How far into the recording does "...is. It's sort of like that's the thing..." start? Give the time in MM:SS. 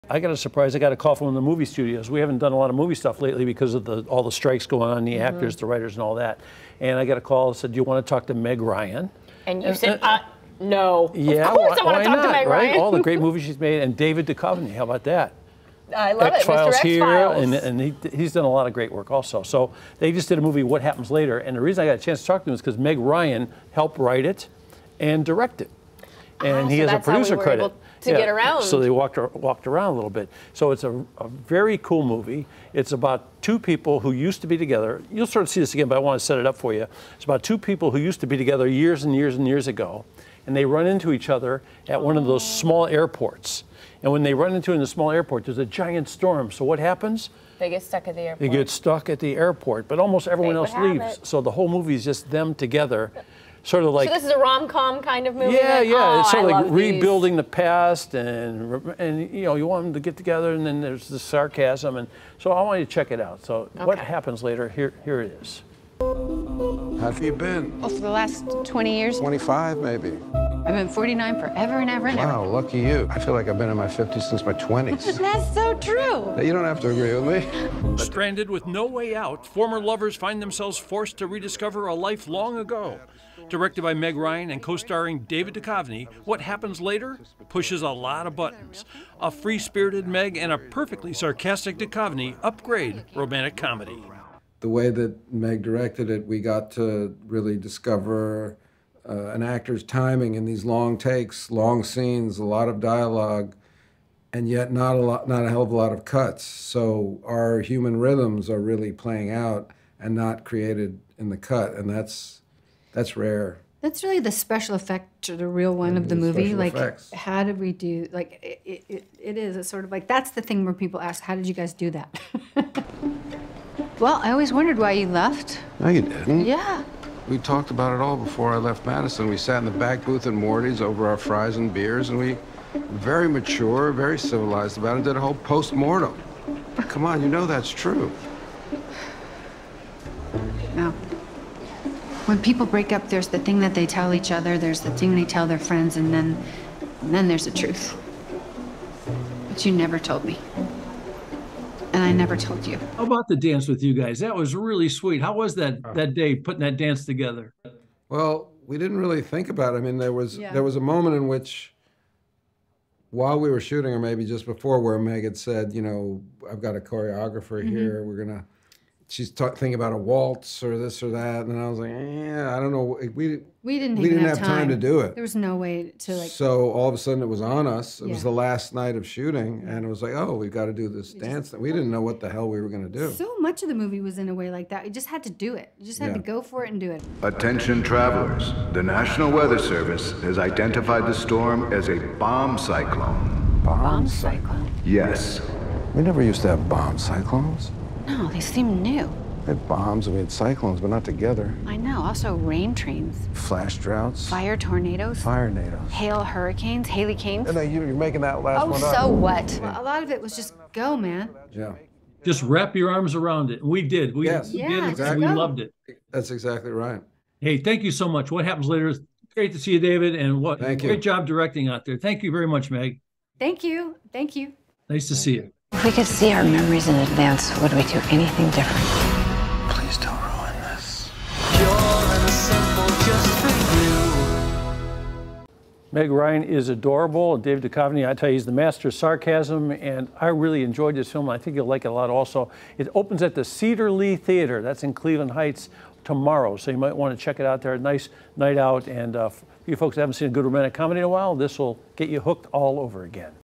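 01:59.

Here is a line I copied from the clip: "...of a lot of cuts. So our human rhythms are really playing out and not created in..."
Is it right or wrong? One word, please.
right.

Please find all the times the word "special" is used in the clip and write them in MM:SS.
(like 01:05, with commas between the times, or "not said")
01:54.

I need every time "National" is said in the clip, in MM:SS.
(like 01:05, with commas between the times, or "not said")
03:08.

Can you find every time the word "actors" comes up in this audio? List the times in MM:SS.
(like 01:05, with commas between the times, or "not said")
00:05, 01:39.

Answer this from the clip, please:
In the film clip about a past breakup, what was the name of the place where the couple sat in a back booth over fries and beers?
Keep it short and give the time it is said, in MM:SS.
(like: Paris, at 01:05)
Morty's, at 02:10.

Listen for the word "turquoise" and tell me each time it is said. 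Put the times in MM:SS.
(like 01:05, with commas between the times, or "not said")
not said.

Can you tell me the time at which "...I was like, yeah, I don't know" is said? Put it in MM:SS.
02:51.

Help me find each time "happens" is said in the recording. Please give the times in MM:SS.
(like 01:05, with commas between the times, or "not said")
00:20, 00:46, 01:03, 01:26, 03:38.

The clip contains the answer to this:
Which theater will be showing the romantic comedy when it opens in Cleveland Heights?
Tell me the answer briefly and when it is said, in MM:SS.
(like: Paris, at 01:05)
Cedar Lee Theater, at 04:03.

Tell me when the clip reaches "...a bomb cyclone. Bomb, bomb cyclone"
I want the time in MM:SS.
03:11.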